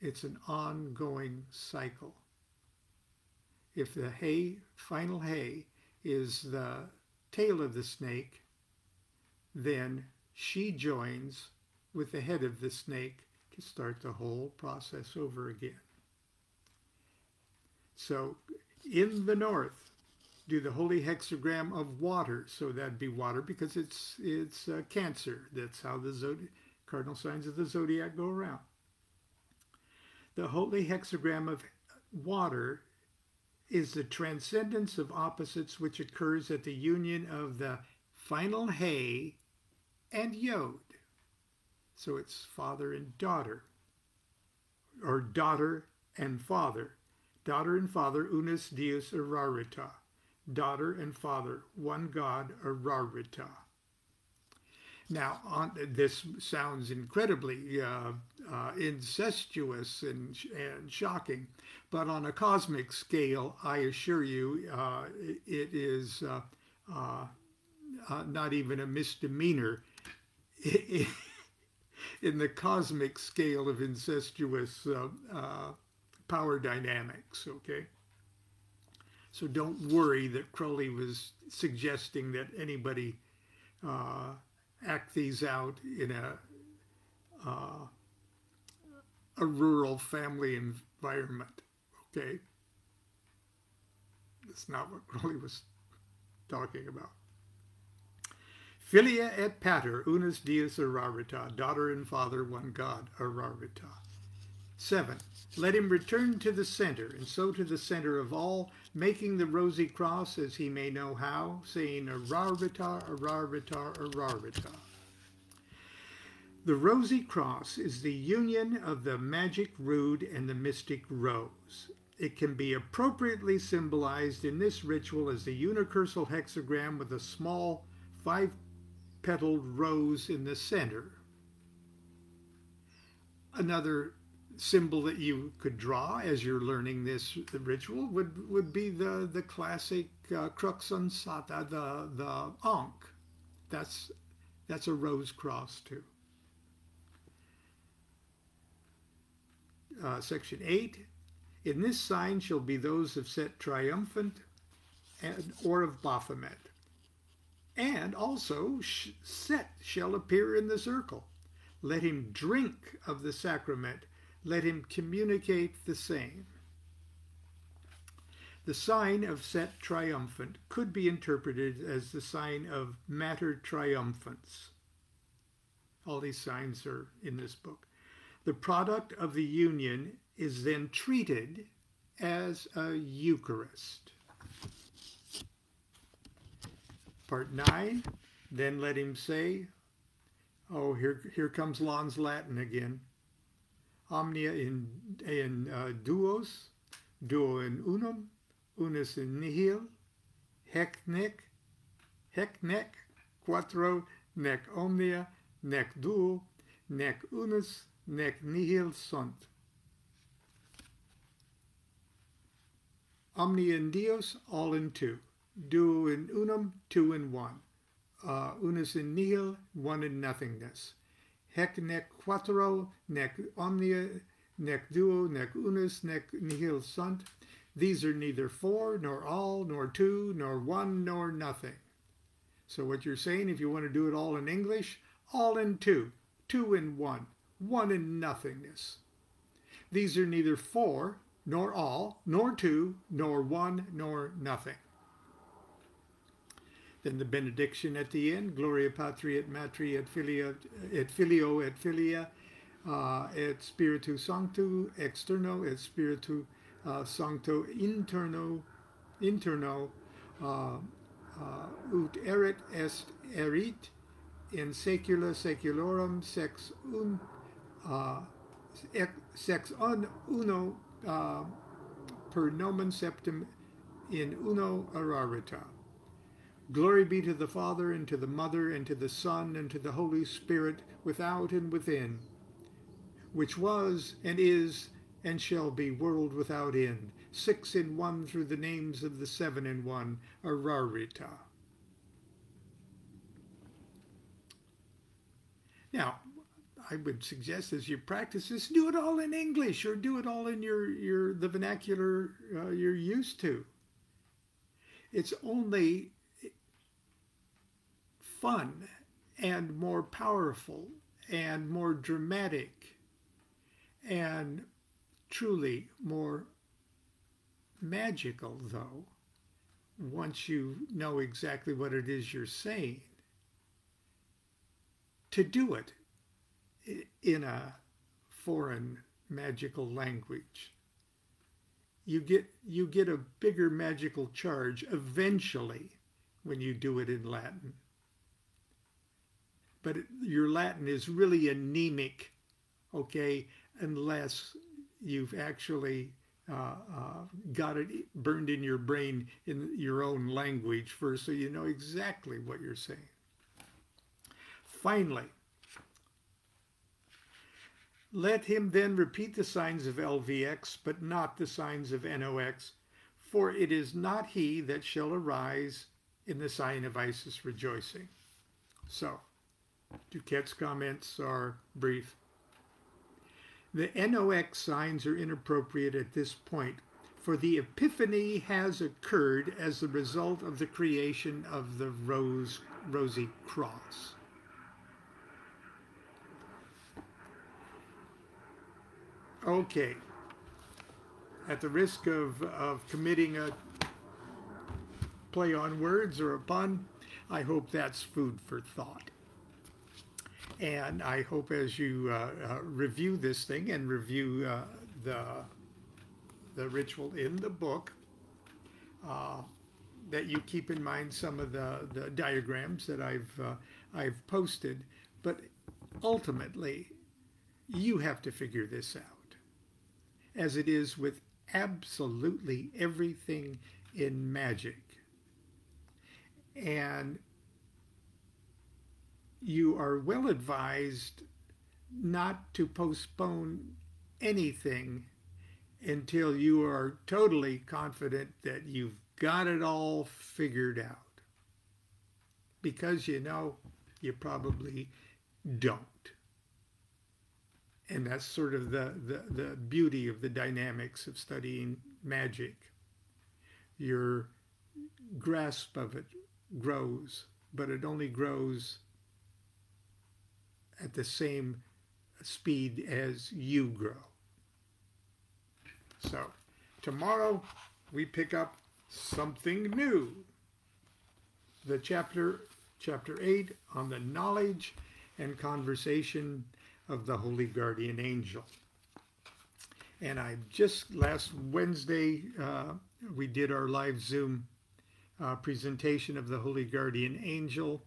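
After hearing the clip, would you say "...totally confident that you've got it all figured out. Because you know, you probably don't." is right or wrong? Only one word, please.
right.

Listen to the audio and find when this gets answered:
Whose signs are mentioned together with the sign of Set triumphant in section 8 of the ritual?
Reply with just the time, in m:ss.
2:36.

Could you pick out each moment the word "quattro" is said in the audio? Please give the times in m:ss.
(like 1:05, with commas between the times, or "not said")
3:23, 3:42.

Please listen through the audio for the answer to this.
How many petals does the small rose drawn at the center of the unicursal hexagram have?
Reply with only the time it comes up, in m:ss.
2:08.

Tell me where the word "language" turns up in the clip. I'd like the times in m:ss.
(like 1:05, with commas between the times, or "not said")
5:29, 5:50.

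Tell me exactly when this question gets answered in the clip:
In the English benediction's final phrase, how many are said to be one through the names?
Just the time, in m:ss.
4:49.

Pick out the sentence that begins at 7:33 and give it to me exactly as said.
Your grasp of it grows, but it only grows at the same speed as you grow.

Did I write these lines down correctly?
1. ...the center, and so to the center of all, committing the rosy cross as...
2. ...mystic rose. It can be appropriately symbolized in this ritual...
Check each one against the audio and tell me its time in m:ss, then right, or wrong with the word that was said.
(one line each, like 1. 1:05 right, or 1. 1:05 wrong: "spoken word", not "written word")
1. 1:46 wrong: "making", not "committing"
2. 2:00 right.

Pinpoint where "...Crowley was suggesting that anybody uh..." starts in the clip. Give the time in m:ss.
1:20.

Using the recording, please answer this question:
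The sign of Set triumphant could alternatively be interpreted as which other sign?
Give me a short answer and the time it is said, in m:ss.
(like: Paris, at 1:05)
Mater Triumphans, at 2:53.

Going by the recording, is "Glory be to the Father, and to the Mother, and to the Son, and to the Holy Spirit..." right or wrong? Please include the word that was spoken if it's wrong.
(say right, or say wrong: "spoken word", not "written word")
right.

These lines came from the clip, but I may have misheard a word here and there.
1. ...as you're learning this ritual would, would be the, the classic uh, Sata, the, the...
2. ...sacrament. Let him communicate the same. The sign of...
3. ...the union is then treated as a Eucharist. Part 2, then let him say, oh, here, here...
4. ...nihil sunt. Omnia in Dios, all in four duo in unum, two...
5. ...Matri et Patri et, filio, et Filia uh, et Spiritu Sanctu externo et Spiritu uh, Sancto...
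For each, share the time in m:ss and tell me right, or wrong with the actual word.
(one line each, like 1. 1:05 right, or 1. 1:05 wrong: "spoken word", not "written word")
1. 2:16 right
2. 2:43 right
3. 2:59 wrong: "9", not "2"
4. 3:28 wrong: "two", not "four"
5. 4:09 wrong: "Filia", not "Patri".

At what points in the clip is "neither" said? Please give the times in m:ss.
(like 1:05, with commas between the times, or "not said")
3:48, 4:00.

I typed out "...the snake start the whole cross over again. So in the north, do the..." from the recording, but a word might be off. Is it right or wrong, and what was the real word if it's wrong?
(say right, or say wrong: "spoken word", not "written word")
wrong: "process", not "cross".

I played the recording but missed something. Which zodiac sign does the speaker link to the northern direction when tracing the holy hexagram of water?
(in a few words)
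Cancer.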